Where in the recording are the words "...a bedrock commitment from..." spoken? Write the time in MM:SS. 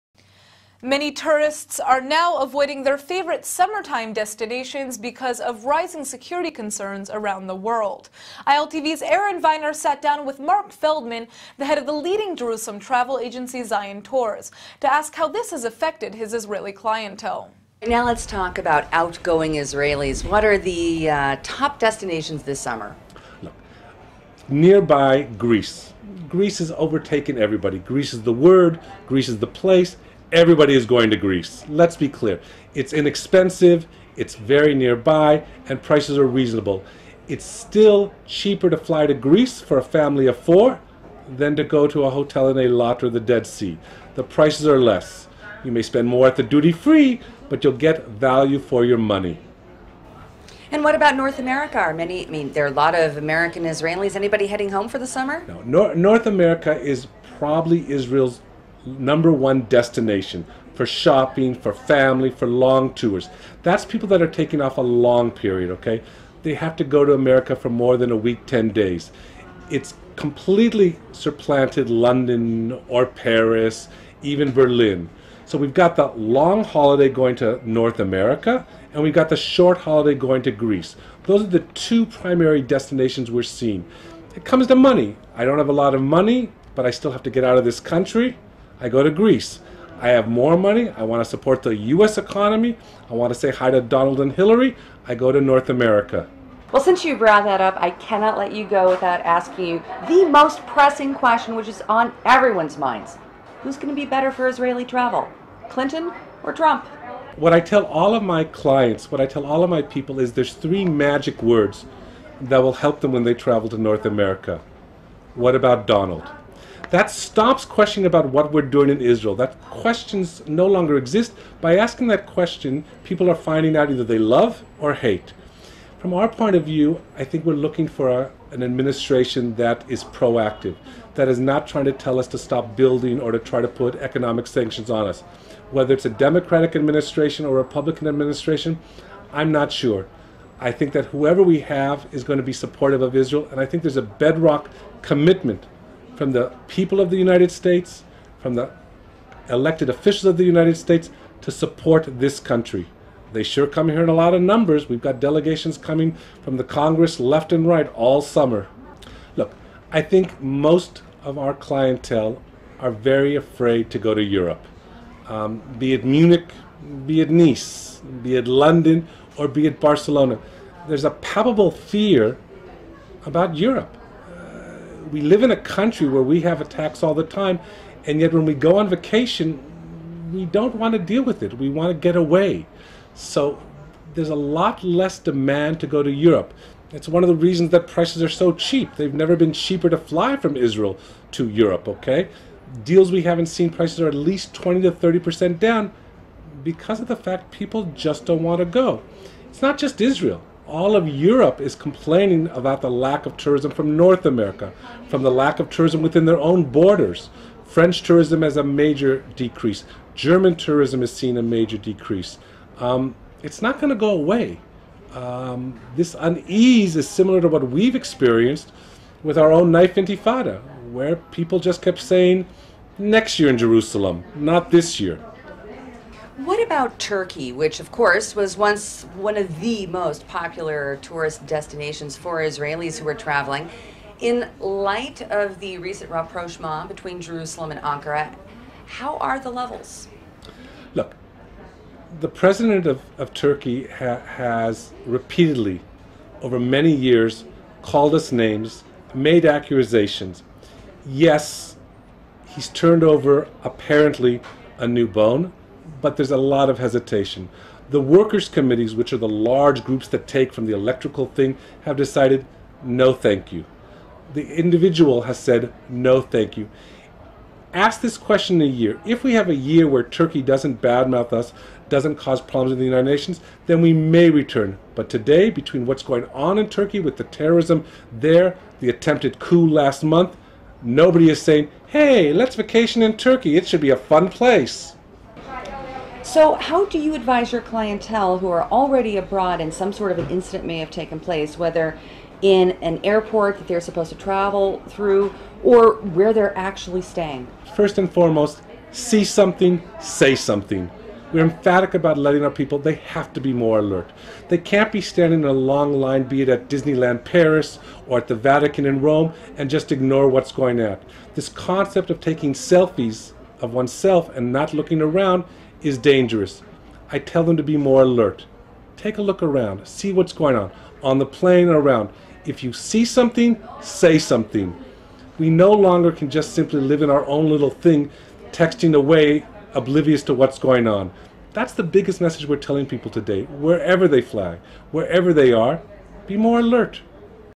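02:23.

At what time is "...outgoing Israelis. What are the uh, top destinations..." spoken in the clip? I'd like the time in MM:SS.
00:18.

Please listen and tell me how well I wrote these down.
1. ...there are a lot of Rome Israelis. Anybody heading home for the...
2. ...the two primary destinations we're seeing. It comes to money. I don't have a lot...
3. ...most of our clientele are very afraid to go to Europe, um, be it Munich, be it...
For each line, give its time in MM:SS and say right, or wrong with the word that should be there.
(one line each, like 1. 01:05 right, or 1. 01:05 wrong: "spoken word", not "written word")
1. 00:52 wrong: "American", not "Rome"
2. 01:21 right
3. 02:40 right.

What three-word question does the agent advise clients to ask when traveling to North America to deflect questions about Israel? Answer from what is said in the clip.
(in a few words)
What about Donald?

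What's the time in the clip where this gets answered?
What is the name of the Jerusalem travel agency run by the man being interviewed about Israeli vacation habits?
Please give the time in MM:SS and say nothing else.
00:13.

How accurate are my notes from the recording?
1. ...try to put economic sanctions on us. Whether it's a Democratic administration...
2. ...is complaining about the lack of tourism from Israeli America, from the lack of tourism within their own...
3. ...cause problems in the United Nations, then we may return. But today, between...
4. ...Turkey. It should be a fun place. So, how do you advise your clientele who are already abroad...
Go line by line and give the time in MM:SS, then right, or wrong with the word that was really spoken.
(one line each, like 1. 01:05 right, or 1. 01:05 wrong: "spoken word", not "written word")
1. 02:13 right
2. 03:21 wrong: "North", not "Israeli"
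3. 04:32 right
4. 04:43 right.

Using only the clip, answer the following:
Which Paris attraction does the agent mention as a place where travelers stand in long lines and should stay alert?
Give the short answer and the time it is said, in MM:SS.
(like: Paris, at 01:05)
Disneyland Paris, at 05:06.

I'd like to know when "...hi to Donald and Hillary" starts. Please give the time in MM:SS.
01:33.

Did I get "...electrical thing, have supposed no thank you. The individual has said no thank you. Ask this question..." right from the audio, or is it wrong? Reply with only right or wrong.
wrong.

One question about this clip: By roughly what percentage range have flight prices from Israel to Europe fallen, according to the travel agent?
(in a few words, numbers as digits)
20 to 30%.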